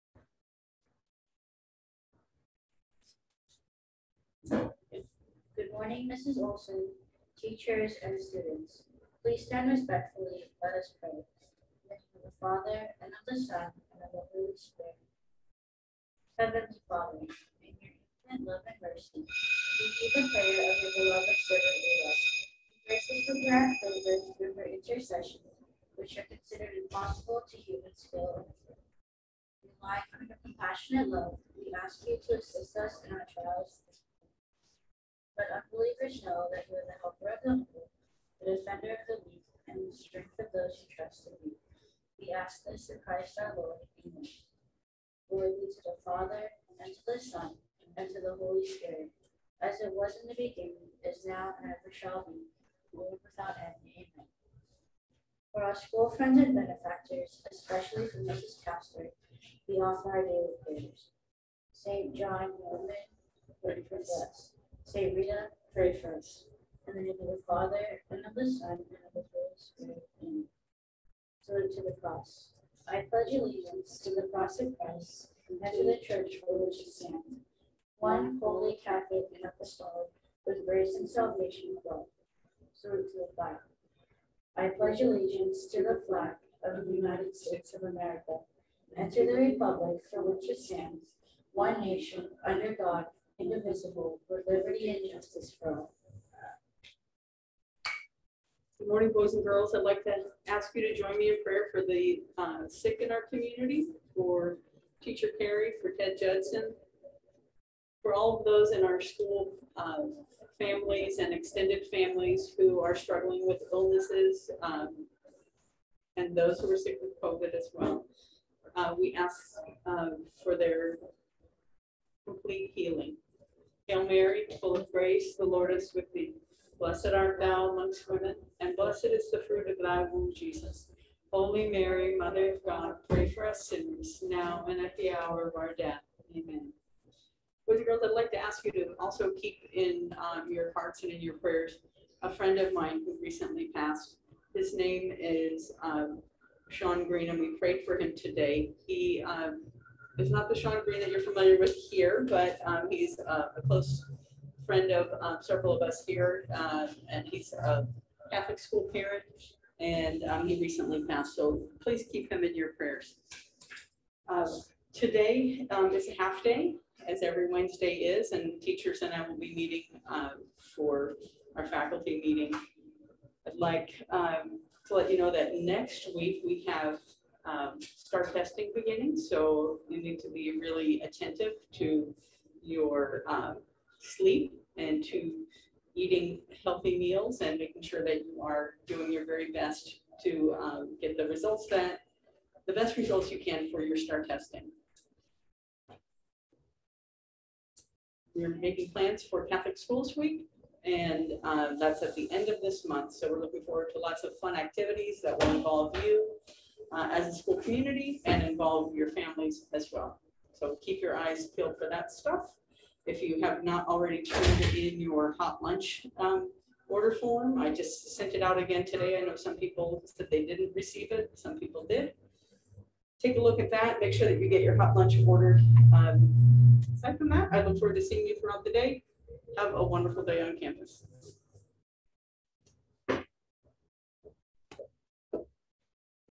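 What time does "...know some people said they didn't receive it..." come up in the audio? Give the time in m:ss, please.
3:39.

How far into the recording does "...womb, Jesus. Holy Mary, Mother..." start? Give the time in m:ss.
2:10.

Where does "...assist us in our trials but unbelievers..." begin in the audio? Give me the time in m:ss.
0:32.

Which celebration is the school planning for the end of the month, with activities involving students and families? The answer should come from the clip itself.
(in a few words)
Catholic Schools Week.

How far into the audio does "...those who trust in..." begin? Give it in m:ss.
0:40.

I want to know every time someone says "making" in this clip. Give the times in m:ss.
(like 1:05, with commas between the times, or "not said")
3:07, 3:18.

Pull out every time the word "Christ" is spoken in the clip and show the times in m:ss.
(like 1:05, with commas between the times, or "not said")
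0:43, 1:14.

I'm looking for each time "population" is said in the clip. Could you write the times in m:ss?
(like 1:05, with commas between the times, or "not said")
not said.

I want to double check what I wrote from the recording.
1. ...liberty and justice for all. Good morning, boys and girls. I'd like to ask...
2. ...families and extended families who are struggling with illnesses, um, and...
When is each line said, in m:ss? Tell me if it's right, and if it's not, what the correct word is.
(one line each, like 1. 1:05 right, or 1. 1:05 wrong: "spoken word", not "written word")
1. 1:34 right
2. 1:50 right.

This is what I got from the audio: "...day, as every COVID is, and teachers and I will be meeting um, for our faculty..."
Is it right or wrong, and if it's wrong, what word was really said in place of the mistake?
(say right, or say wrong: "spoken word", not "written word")
wrong: "Wednesday", not "COVID".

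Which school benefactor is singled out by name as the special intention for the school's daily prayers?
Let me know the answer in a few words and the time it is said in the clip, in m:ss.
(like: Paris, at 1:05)
Mrs. Castor, at 0:58.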